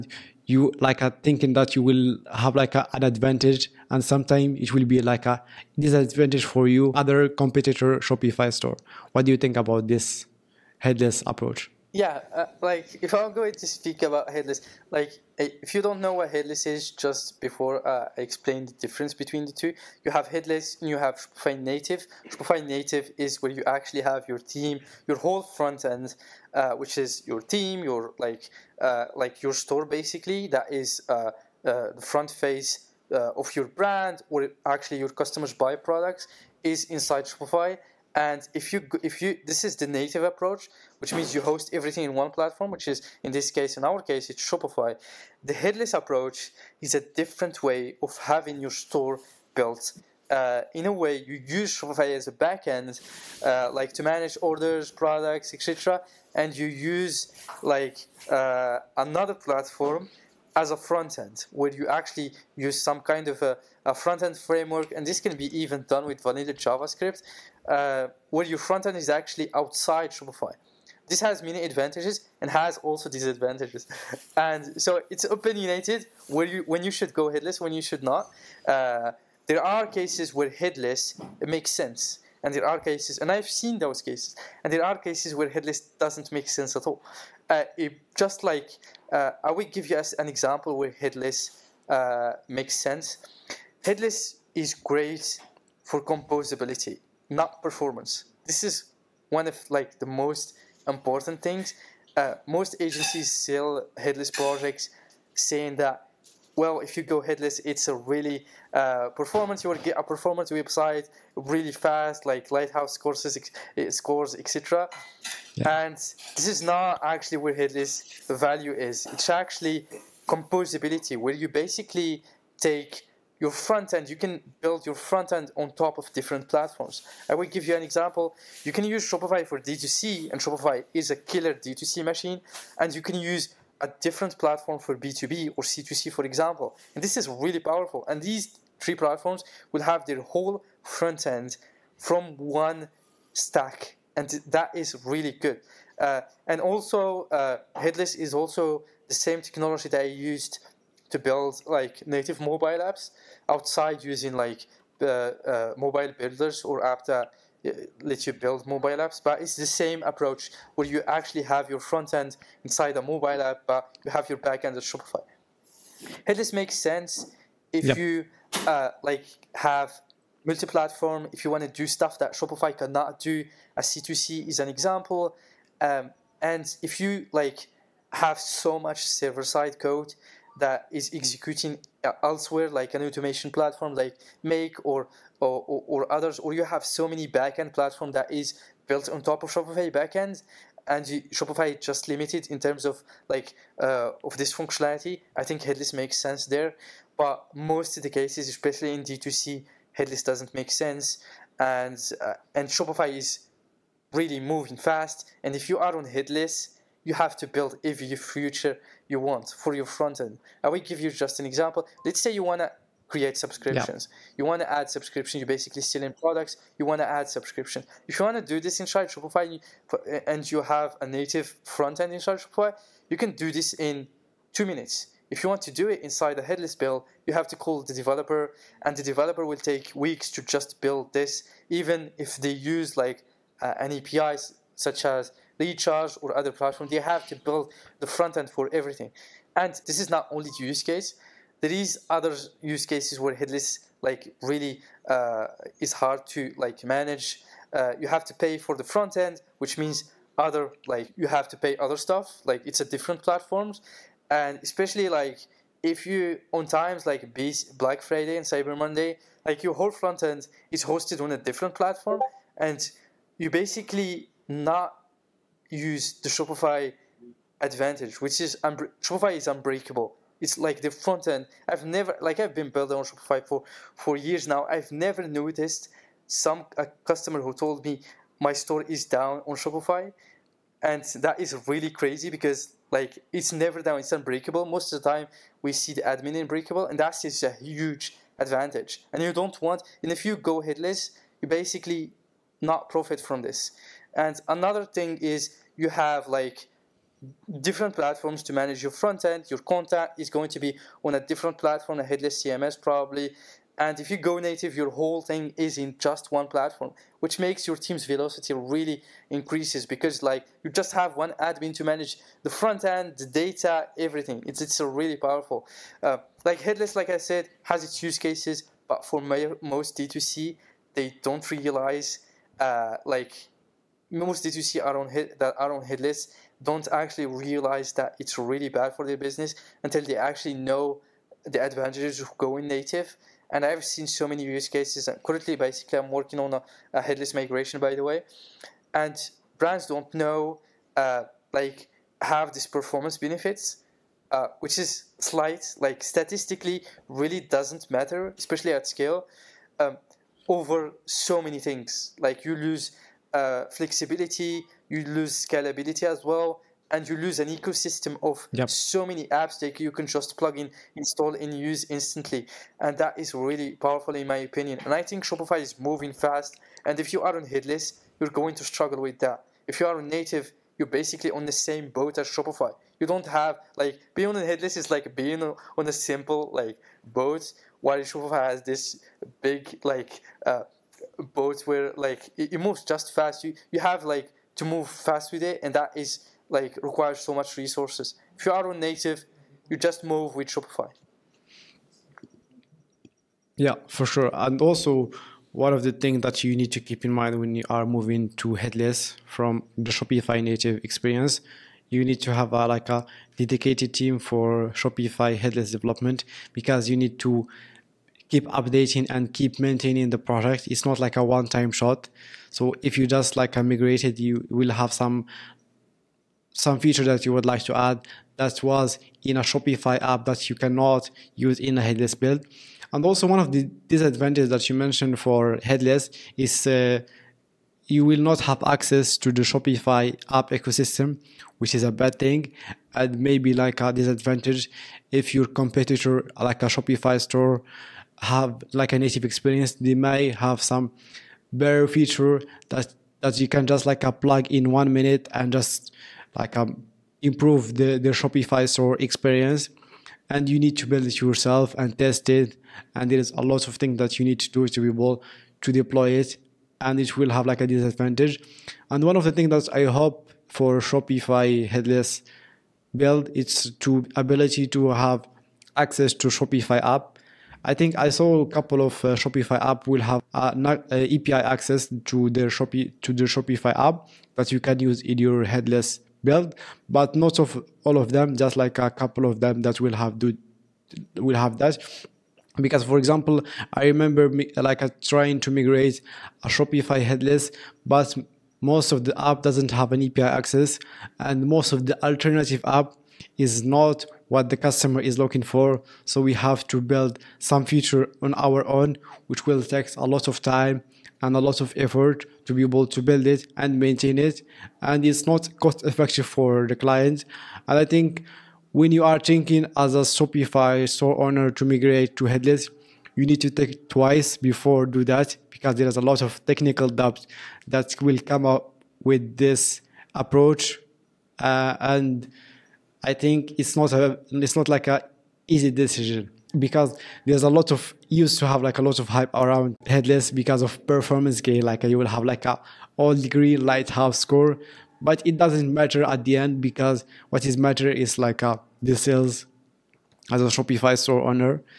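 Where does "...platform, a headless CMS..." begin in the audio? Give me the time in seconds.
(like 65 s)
301 s.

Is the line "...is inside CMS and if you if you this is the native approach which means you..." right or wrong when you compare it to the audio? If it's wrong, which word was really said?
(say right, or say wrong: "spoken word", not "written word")
wrong: "Shopify", not "CMS".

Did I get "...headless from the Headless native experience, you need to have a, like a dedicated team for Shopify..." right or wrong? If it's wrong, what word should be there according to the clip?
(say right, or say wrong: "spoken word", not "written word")
wrong: "Shopify", not "Headless".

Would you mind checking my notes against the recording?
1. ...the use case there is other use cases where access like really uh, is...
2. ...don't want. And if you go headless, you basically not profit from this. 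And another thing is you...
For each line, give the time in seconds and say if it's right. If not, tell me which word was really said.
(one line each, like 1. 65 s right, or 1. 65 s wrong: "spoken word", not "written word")
1. 240 s wrong: "headless", not "access"
2. 289 s right.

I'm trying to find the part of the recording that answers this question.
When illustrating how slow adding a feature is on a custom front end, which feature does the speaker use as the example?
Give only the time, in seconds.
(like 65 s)
213 s.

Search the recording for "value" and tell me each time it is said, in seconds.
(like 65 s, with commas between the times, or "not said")
118 s.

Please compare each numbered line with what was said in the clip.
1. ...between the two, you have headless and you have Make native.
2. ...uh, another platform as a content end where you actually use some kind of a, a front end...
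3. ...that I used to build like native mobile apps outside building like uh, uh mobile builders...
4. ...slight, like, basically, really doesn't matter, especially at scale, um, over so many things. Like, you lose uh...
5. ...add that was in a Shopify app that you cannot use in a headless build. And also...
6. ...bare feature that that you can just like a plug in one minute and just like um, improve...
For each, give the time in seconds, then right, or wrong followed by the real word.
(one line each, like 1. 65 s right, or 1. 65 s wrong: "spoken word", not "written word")
1. 19 s wrong: "Shopify", not "Make"
2. 58 s wrong: "front", not "content"
3. 149 s wrong: "using", not "building"
4. 345 s wrong: "statistically", not "basically"
5. 417 s right
6. 441 s right.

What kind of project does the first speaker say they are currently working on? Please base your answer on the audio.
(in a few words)
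Headless migration.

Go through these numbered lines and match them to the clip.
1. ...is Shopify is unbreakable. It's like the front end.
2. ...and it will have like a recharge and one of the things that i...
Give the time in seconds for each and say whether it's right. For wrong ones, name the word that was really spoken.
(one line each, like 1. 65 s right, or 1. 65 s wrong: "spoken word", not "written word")
1. 268 s right
2. 456 s wrong: "disadvantage", not "recharge".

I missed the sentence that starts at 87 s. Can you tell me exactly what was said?
Uh, it, just like uh, I will give you an example where headless uh, makes sense.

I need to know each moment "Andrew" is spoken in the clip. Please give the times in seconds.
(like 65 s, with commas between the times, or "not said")
not said.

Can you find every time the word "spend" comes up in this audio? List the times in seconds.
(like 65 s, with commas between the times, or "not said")
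not said.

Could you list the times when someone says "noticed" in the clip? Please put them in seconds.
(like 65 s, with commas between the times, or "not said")
275 s.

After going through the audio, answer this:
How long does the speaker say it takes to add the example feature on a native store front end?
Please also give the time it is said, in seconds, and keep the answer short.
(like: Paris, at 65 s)
2 minutes, at 224 s.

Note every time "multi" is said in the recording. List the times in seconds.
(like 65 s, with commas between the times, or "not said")
170 s.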